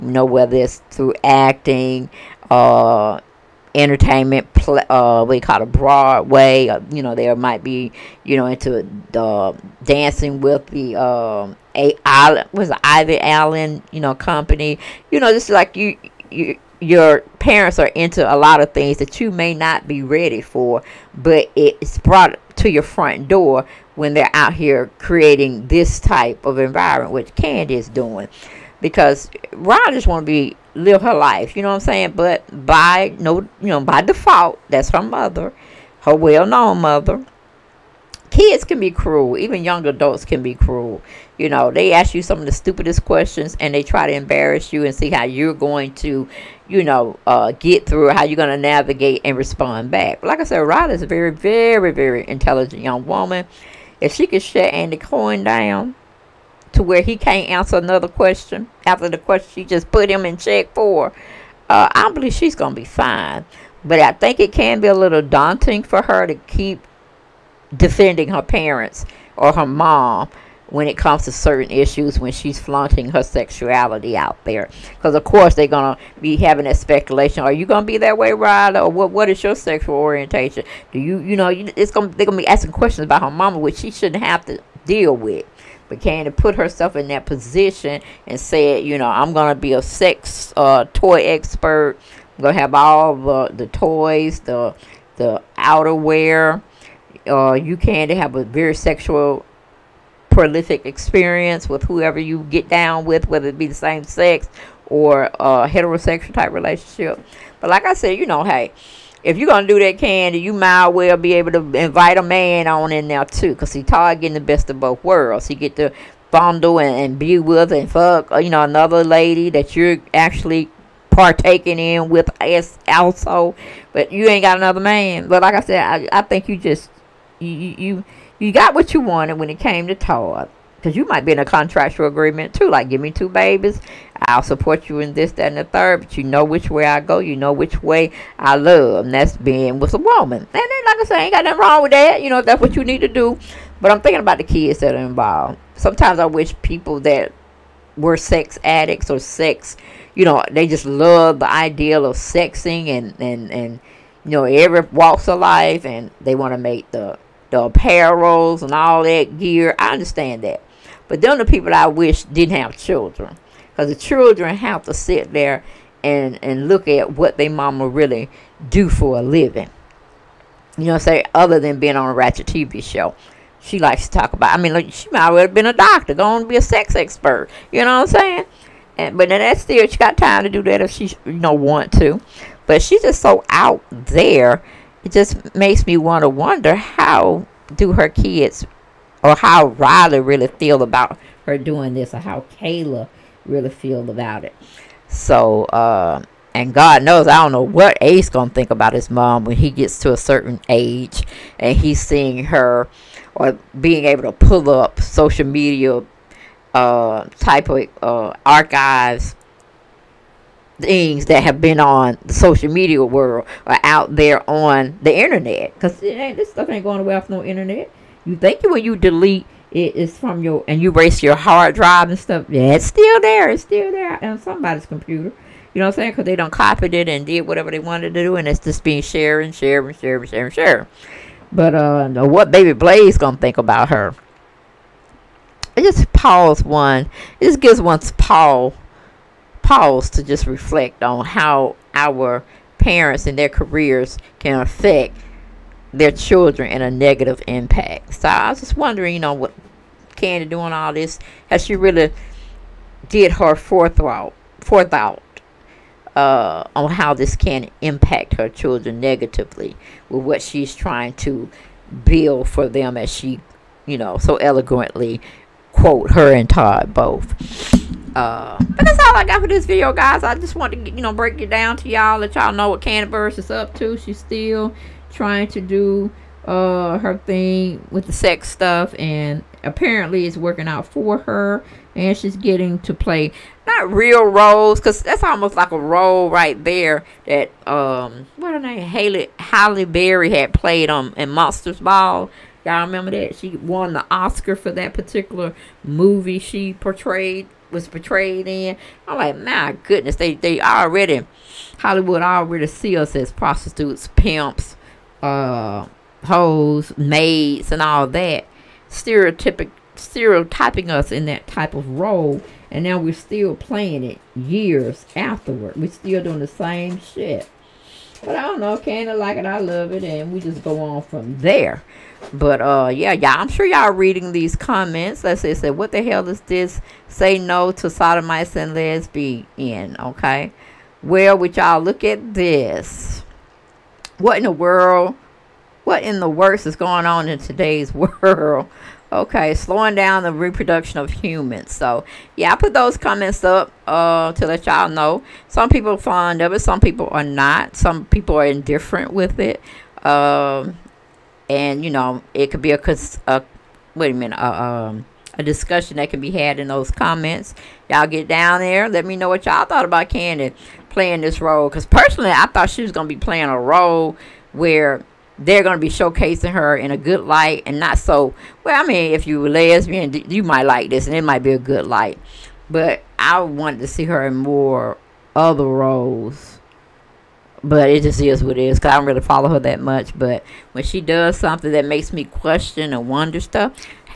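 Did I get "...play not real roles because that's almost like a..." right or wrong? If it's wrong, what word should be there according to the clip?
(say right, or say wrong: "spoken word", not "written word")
right.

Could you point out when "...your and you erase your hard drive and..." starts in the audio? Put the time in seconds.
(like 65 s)
220 s.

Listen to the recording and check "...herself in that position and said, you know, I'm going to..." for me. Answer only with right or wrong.
right.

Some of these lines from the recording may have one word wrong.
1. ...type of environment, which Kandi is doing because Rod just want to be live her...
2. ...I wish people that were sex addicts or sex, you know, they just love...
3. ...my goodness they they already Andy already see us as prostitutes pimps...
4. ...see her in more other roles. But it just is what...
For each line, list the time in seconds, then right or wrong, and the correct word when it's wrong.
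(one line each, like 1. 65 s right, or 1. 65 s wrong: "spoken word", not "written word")
1. 26 s right
2. 146 s right
3. 299 s wrong: "Hollywood", not "Andy"
4. 373 s right.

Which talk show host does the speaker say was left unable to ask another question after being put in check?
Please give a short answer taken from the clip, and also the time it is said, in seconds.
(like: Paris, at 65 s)
Andy Cohen, at 54 s.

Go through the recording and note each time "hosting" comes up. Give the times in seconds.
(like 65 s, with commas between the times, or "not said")
not said.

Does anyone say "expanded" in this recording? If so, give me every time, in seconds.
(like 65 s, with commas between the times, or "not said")
not said.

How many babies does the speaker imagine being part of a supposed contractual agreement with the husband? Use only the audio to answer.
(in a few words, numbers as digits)
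2.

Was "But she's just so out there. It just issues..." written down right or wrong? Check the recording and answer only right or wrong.
wrong.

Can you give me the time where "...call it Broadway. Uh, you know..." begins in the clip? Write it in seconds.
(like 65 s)
5 s.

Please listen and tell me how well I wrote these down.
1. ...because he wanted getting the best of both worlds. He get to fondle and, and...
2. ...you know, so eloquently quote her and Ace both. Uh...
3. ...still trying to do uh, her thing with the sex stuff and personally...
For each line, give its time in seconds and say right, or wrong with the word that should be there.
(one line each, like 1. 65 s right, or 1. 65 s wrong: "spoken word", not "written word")
1. 113 s wrong: "tired", not "wanted"
2. 263 s wrong: "Todd", not "Ace"
3. 274 s wrong: "apparently", not "personally".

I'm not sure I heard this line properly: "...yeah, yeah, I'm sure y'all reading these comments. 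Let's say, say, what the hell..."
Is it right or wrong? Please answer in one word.
right.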